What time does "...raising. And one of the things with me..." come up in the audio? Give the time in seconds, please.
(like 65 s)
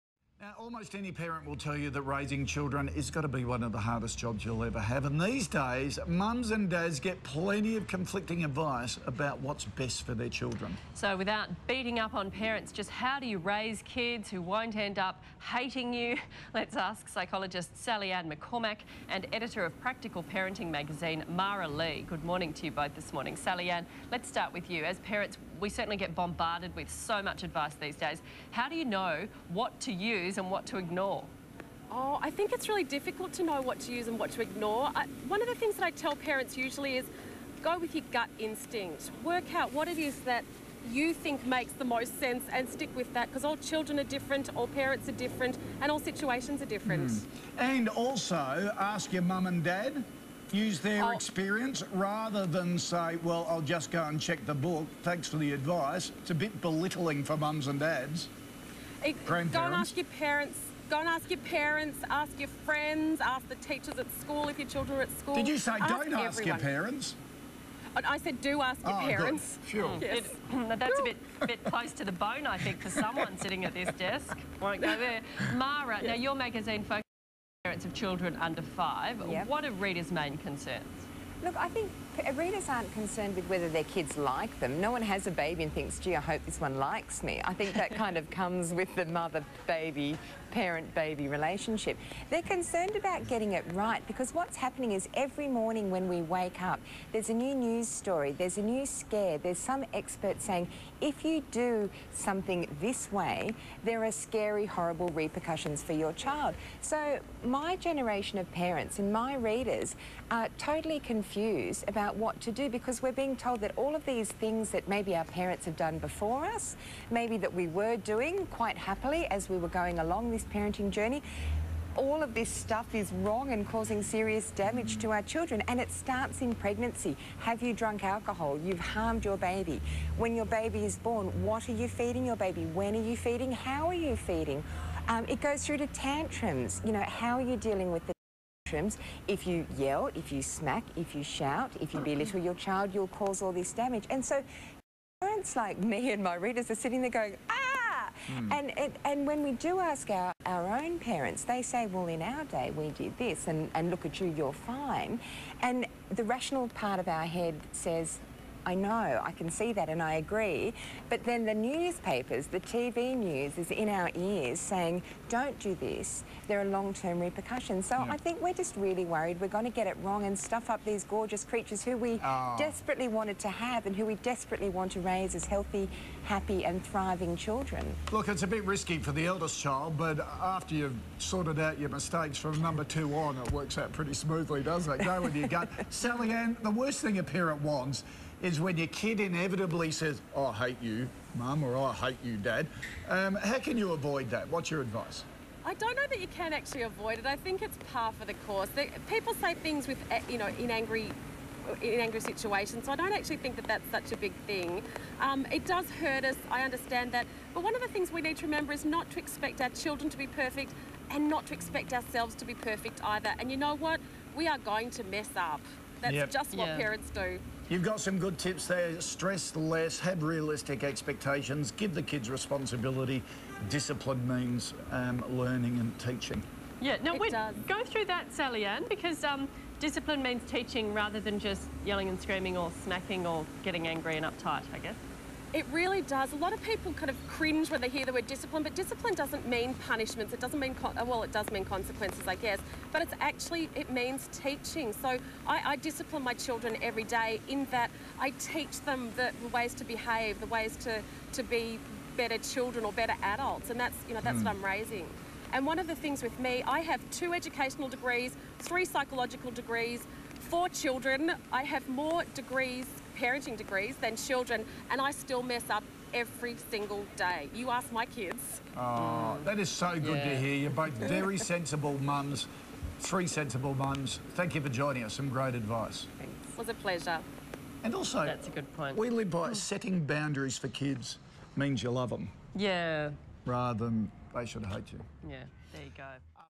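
254 s.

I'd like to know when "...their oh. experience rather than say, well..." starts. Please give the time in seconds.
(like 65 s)
50 s.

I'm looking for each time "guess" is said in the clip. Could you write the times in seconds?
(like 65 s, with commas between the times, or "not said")
234 s, 242 s.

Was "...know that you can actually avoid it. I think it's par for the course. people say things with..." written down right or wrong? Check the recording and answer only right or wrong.
right.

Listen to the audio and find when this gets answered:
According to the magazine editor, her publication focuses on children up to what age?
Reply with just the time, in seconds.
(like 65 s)
78 s.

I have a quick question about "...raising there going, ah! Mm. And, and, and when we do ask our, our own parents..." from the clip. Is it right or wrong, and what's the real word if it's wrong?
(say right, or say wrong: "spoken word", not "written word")
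wrong: "sitting", not "raising".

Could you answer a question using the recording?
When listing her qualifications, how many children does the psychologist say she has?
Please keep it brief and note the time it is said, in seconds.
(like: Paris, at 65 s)
4, at 260 s.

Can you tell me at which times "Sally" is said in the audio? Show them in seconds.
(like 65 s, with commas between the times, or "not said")
17 s, 23 s, 185 s, 228 s.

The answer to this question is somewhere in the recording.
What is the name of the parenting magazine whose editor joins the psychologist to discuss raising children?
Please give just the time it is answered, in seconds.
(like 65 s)
19 s.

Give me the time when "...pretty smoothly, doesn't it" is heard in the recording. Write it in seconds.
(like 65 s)
183 s.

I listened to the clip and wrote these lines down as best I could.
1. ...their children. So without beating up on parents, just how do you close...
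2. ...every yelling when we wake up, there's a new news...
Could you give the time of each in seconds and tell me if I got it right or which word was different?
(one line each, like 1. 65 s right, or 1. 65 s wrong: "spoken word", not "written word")
1. 10 s wrong: "raise", not "close"
2. 95 s wrong: "morning", not "yelling".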